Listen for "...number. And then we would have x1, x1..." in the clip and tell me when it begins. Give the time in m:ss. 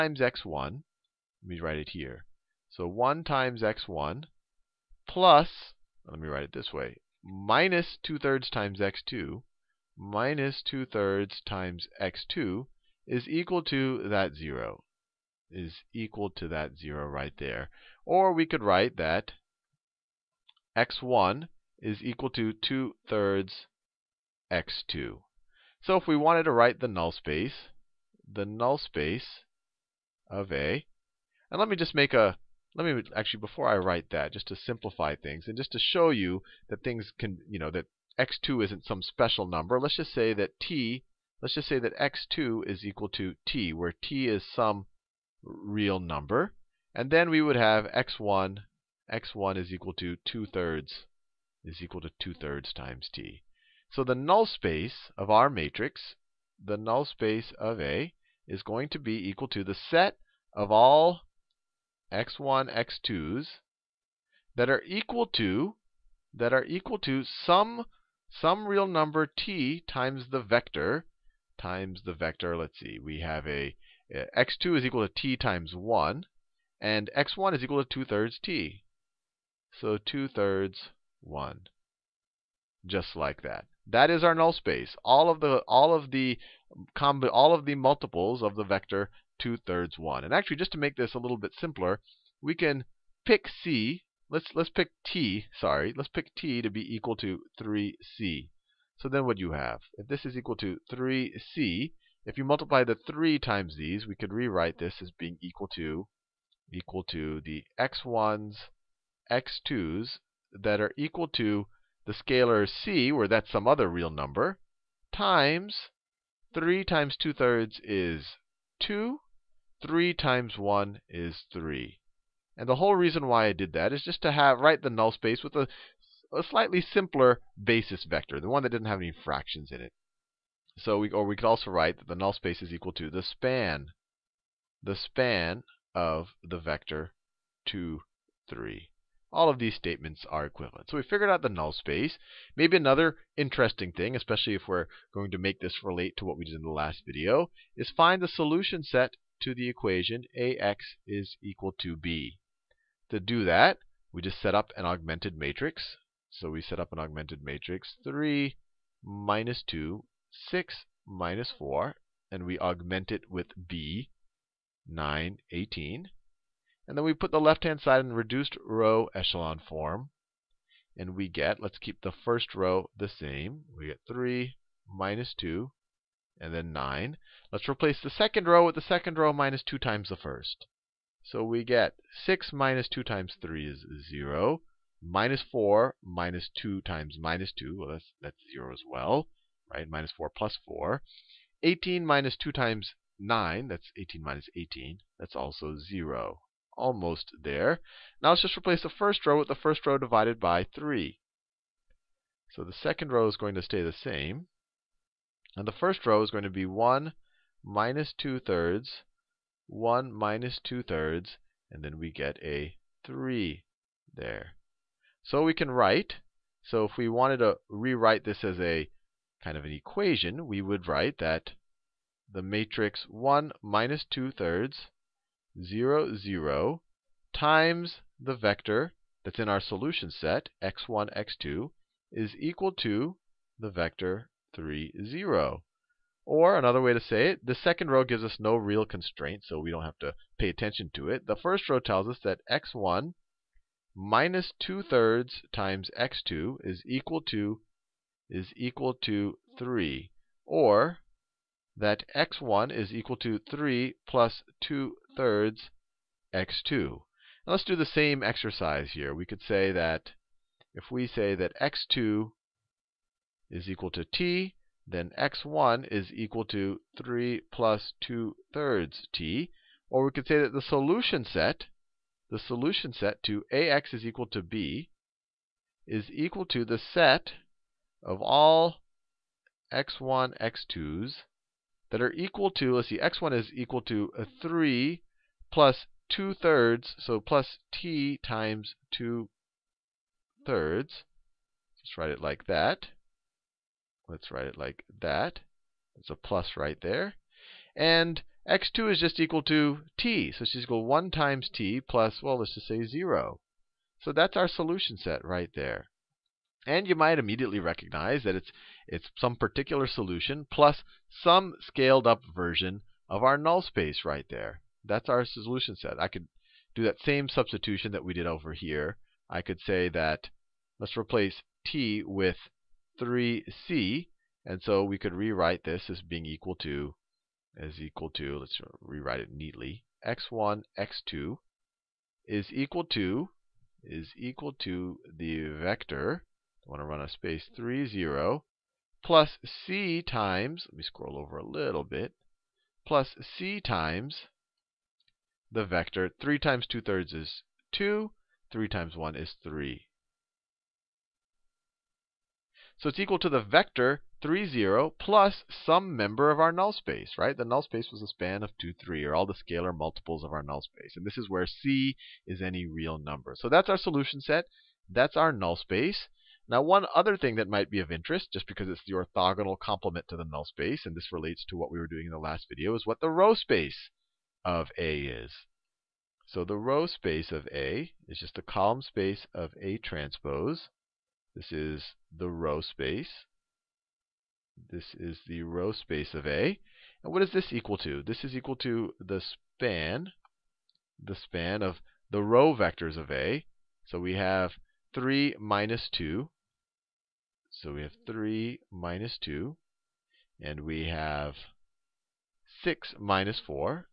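0:46.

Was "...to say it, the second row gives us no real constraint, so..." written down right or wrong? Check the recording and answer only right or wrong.
right.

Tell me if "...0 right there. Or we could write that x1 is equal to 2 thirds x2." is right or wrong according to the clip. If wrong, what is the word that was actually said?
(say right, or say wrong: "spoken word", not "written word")
right.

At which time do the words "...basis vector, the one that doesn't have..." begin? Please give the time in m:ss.
2:07.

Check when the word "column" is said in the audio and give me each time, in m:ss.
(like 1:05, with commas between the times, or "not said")
6:18.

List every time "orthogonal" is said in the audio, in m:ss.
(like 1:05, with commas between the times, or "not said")
6:08.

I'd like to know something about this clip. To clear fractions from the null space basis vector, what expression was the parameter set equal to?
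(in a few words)
3c.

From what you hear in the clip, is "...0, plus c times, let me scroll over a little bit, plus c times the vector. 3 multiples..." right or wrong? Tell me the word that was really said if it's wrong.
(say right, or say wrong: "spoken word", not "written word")
wrong: "times", not "multiples".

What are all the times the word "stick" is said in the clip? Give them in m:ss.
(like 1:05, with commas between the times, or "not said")
not said.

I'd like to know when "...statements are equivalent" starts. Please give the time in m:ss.
2:19.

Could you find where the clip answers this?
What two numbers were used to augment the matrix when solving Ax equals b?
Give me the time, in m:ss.
2:44.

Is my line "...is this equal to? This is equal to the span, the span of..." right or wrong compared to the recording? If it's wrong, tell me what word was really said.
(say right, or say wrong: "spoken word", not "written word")
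right.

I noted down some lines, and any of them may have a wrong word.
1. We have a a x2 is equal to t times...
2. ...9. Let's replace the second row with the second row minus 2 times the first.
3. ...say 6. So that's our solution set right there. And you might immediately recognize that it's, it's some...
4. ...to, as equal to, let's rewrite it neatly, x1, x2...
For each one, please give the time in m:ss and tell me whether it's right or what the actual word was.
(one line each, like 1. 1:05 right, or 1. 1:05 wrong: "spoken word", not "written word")
1. 1:12 right
2. 2:56 right
3. 5:02 wrong: "0", not "6"
4. 5:26 right.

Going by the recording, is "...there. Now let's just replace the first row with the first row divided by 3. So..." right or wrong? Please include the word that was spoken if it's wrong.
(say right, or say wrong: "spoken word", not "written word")
right.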